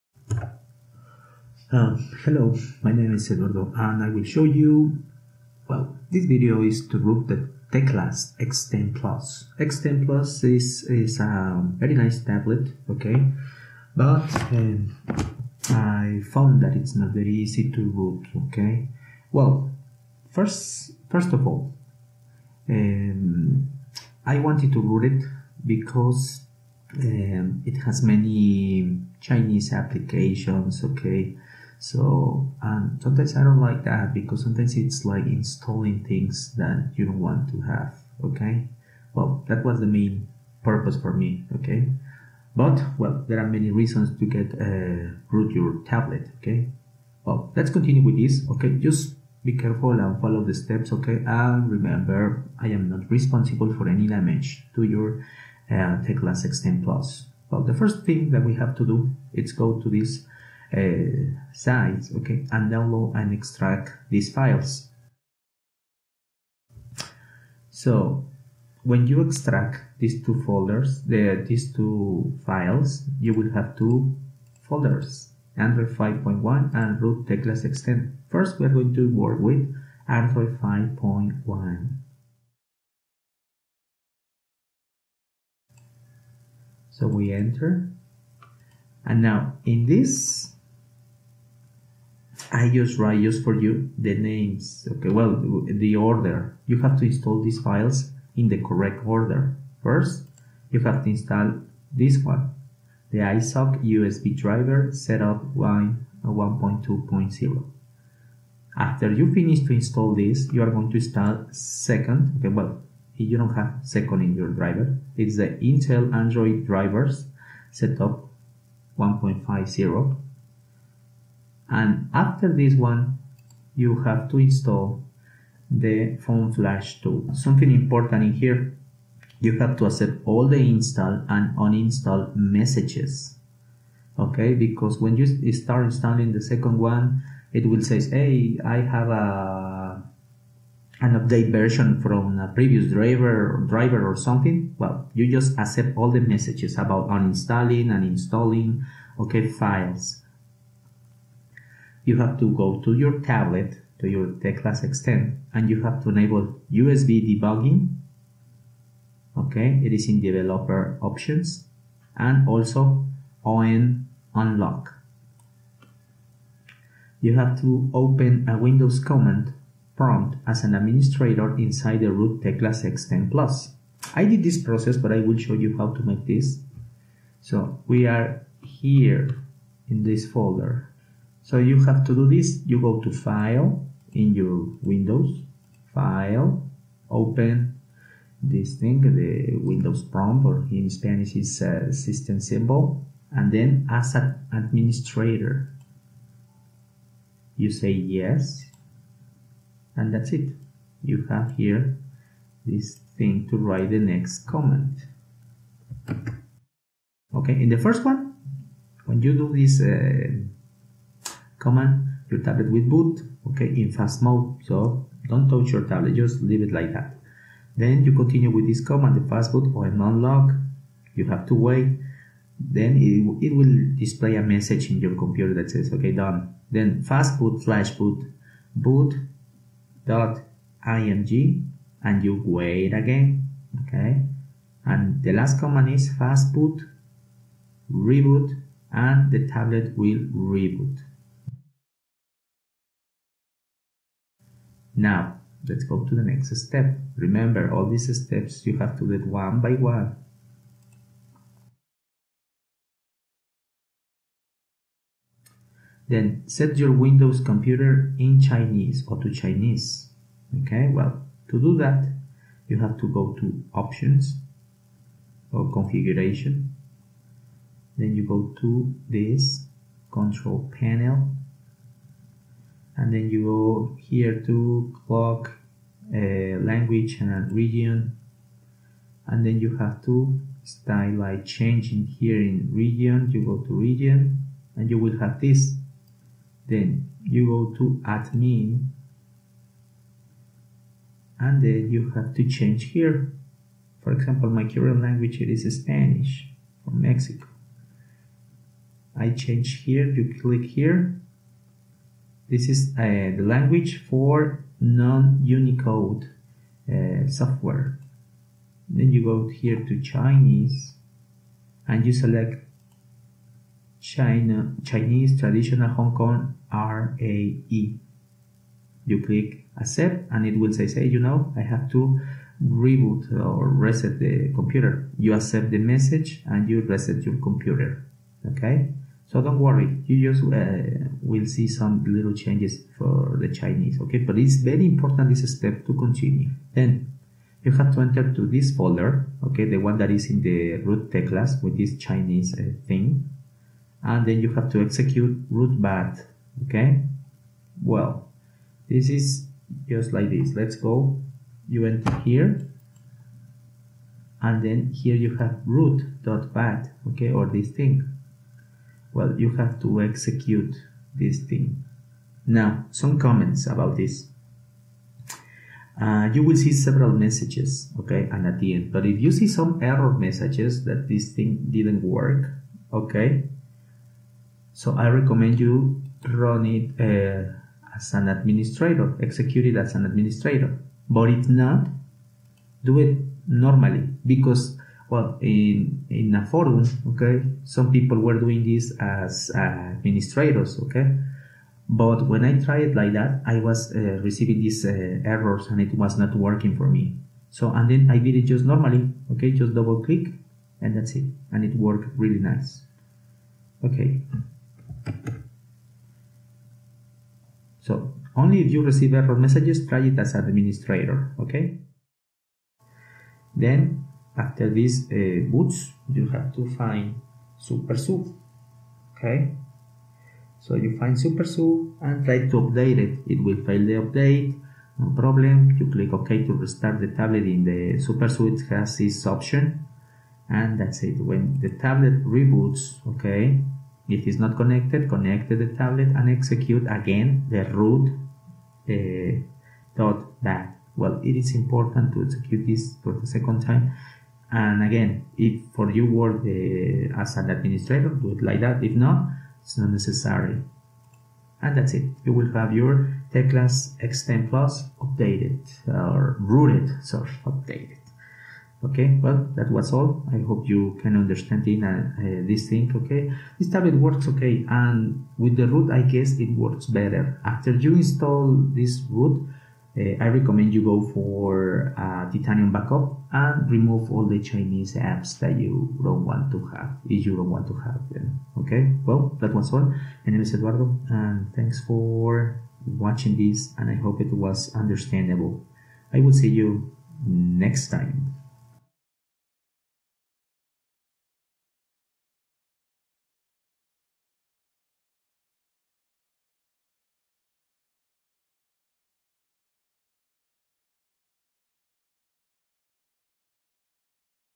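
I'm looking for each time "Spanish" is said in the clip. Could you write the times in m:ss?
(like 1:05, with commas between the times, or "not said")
3:10, 4:55.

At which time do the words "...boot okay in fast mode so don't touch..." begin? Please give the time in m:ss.
3:32.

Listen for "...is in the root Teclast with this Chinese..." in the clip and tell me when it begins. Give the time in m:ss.
5:40.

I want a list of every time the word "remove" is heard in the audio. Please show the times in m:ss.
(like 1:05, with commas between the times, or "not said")
7:53.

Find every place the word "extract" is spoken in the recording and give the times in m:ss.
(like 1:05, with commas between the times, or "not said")
1:03, 1:09.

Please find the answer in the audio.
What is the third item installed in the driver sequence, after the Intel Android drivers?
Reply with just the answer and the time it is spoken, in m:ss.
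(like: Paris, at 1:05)
phone flash tool, at 2:06.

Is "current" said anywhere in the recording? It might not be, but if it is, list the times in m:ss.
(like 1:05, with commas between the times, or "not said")
4:54.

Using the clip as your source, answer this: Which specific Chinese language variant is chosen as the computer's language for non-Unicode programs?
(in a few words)
Chinese Traditional Hong Kong.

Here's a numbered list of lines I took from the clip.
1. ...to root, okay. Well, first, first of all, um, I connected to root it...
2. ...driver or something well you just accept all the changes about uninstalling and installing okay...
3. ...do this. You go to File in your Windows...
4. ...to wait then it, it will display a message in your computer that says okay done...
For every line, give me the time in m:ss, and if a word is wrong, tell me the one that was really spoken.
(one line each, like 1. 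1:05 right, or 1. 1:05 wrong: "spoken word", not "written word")
1. 0:17 wrong: "wanted", not "connected"
2. 2:23 wrong: "messages", not "changes"
3. 3:02 right
4. 3:41 right.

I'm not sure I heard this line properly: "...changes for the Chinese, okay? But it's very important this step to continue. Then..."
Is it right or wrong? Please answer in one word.
right.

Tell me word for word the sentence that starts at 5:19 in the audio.
You click accept and it will say, say you know, I have to reboot or reset the computer.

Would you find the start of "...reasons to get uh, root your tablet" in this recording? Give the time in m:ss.
0:43.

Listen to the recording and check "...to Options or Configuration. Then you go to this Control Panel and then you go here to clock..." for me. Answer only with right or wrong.
right.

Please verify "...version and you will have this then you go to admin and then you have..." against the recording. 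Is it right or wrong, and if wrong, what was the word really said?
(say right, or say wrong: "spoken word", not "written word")
wrong: "region", not "version".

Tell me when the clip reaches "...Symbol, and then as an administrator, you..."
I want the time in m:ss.
3:12.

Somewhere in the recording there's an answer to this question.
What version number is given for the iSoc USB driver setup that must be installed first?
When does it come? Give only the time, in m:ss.
1:45.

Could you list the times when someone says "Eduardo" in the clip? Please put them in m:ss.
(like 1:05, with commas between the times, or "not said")
0:03, 8:00.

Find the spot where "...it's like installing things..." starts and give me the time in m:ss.
0:34.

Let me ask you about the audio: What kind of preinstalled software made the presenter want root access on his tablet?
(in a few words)
Chinese applications.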